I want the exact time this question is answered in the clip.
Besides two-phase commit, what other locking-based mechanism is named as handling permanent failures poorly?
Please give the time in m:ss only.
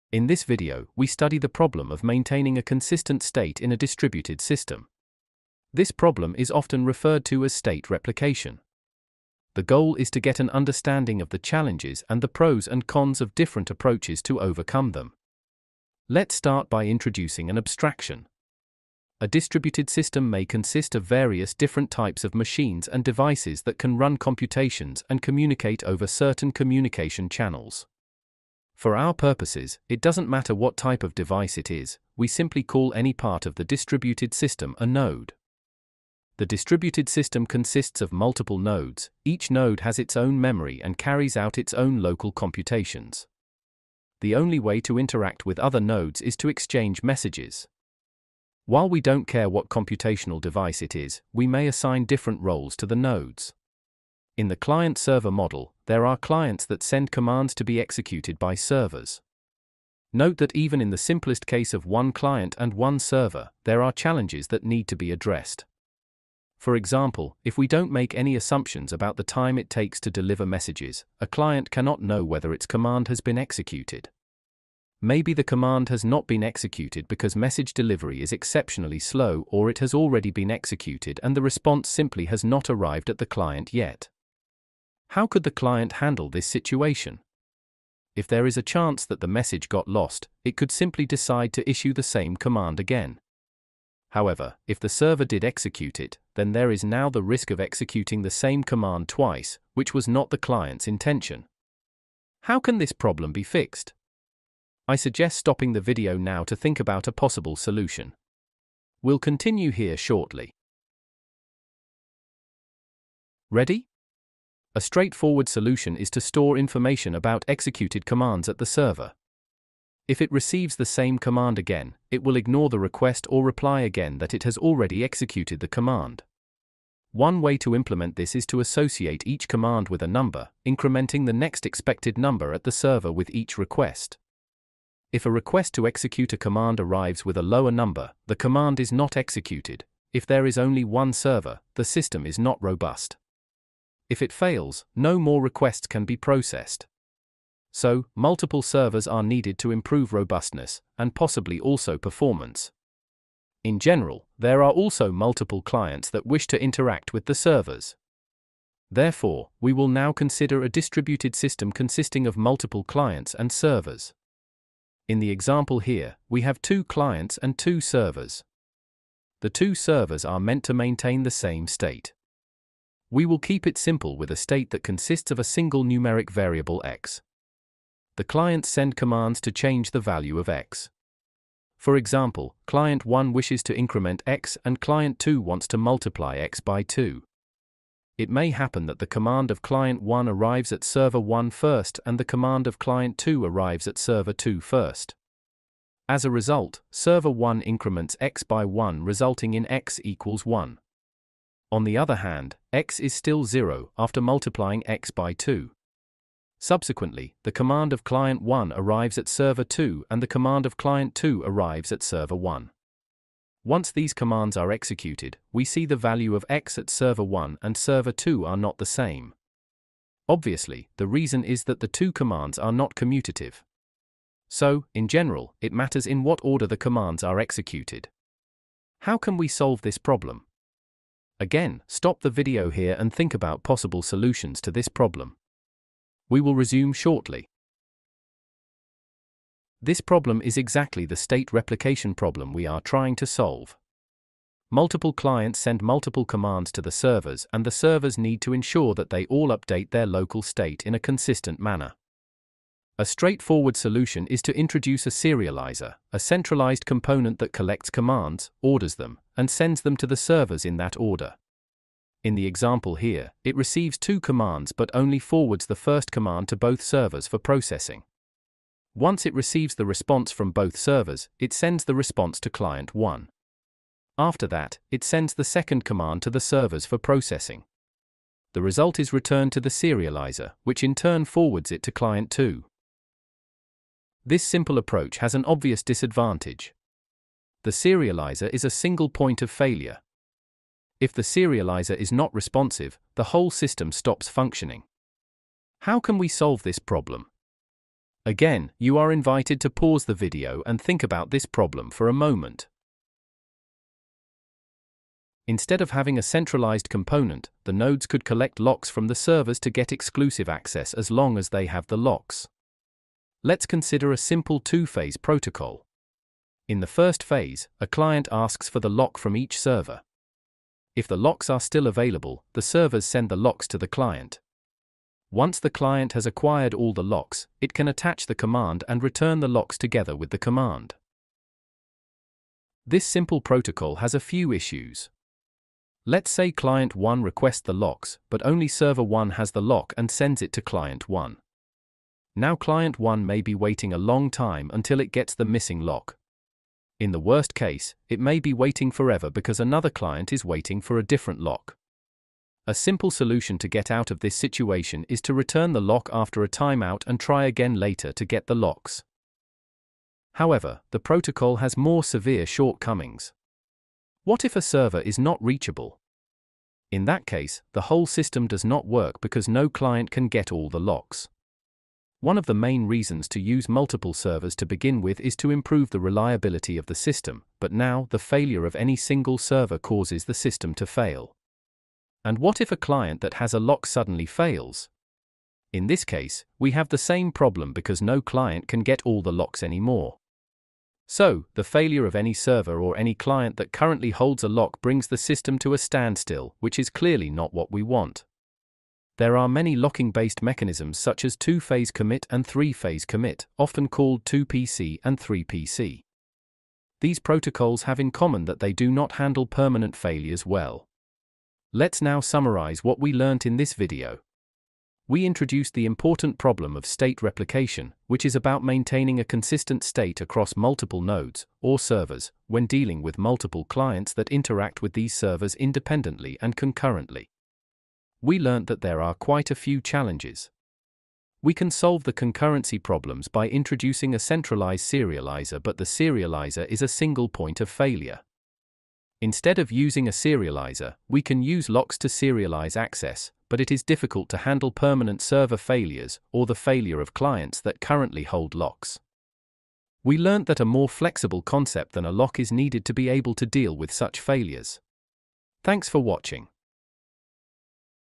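6:42.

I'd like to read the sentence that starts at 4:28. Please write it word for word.
Once it receives the response from both servers, it sends the response to client 1.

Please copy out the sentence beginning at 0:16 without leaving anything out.
Let's start by introducing an abstraction.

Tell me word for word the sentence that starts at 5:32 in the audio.
This simple protocol has a few issues.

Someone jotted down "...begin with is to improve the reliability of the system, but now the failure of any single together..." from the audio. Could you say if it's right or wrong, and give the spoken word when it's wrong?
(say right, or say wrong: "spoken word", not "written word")
wrong: "server", not "together".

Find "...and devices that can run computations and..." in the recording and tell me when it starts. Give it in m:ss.
0:22.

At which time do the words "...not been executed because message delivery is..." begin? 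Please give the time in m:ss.
1:16.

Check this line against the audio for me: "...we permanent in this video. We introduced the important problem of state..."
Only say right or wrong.
wrong.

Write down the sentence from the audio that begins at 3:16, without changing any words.
As a result, server 1 increments x by 1 resulting in x equals 1.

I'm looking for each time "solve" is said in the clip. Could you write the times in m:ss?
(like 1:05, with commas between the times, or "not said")
3:49, 4:03, 4:56, 7:11.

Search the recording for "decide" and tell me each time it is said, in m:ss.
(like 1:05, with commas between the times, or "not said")
1:31.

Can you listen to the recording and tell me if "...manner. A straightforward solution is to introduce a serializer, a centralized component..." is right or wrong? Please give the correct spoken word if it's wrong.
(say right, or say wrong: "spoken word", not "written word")
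right.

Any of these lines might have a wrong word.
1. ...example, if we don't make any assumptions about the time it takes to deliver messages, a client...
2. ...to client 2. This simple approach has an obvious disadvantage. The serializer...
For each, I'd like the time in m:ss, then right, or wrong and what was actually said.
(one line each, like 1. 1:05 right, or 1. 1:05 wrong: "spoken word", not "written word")
1. 1:06 right
2. 4:41 right.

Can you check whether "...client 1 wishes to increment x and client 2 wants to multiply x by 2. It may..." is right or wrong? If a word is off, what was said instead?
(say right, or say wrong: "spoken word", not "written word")
right.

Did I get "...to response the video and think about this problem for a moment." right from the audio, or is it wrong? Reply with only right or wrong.
wrong.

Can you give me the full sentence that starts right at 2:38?
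Therefore, we will now consider a distributed system consisting of multiple clients and servers.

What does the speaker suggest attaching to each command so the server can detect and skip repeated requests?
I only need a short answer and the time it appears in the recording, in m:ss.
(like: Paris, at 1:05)
a number, at 2:08.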